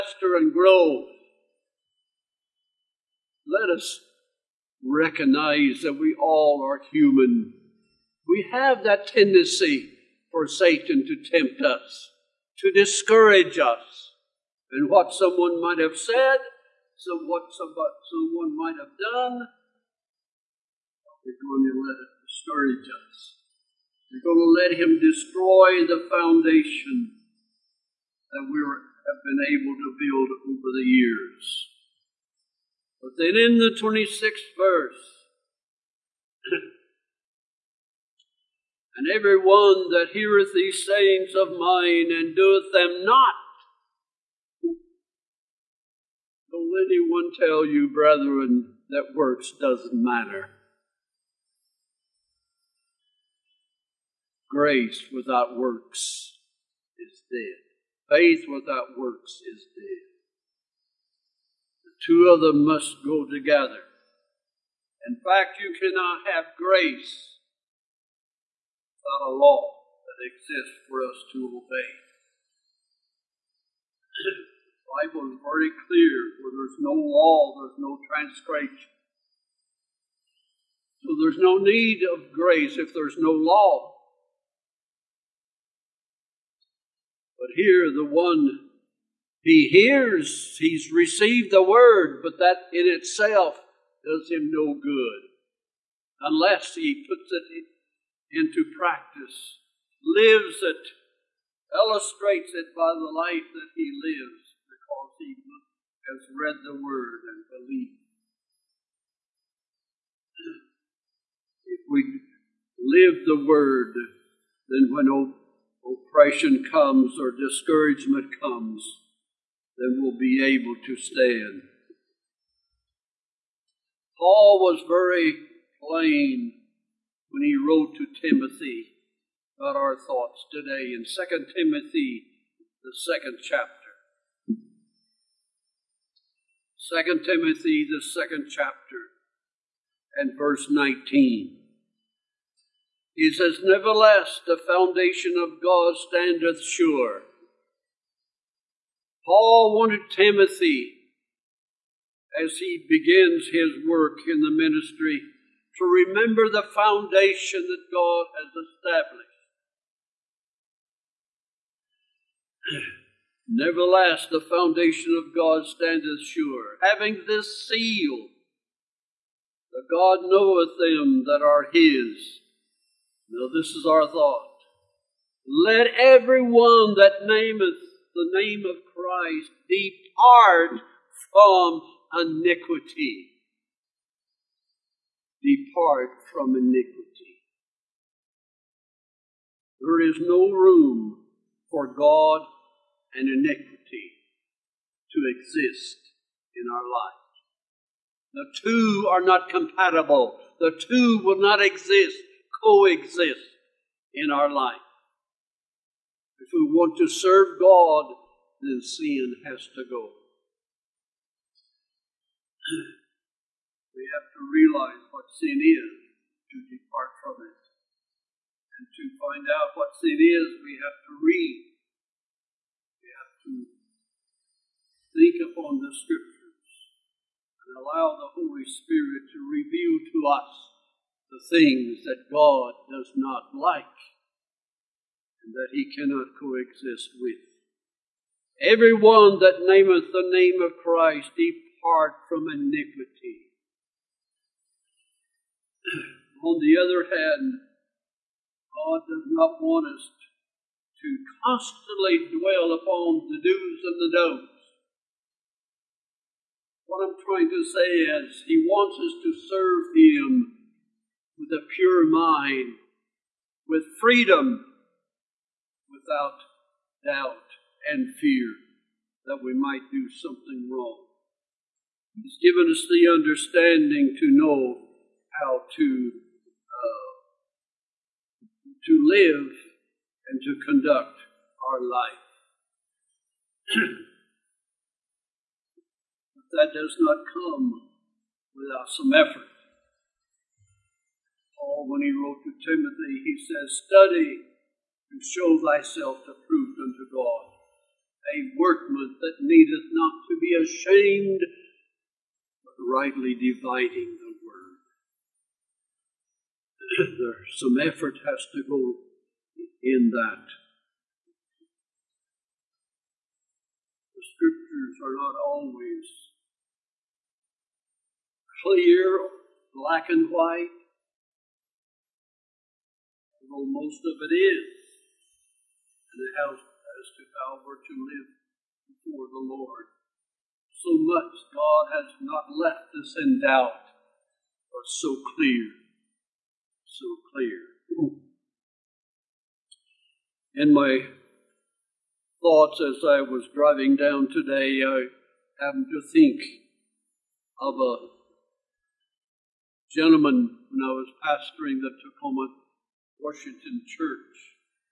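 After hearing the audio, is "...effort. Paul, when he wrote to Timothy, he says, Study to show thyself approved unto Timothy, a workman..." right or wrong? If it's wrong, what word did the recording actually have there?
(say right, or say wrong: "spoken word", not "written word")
wrong: "God", not "Timothy".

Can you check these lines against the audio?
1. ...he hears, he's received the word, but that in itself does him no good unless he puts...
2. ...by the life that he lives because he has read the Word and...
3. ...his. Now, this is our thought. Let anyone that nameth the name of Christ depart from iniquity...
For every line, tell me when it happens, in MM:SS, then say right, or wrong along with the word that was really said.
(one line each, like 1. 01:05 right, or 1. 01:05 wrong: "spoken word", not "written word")
1. 01:29 right
2. 01:42 right
3. 02:51 wrong: "everyone", not "anyone".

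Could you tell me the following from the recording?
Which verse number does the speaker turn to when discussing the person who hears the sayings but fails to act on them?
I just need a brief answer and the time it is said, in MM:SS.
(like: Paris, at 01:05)
26th verse, at 00:33.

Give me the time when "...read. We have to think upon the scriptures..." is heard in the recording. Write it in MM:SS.
03:41.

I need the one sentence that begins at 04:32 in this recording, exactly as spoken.
He's given us the understanding to know how to uh, to live and to conduct our life.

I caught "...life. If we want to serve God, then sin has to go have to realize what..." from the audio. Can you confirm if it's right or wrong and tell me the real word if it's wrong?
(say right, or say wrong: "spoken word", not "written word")
right.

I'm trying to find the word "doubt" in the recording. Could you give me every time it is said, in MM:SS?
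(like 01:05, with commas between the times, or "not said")
04:27, 05:33.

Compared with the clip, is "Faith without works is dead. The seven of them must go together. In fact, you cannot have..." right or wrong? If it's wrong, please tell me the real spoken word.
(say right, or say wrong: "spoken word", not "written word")
wrong: "two", not "seven".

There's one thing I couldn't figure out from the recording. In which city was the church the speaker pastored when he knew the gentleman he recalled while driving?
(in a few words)
Tacoma, Washington.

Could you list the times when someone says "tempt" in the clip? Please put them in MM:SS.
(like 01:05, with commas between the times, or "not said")
00:11.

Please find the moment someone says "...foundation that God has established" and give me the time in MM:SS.
02:36.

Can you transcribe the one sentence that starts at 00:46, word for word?
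Don't let anyone tell you, brethren, that works doesn't matter.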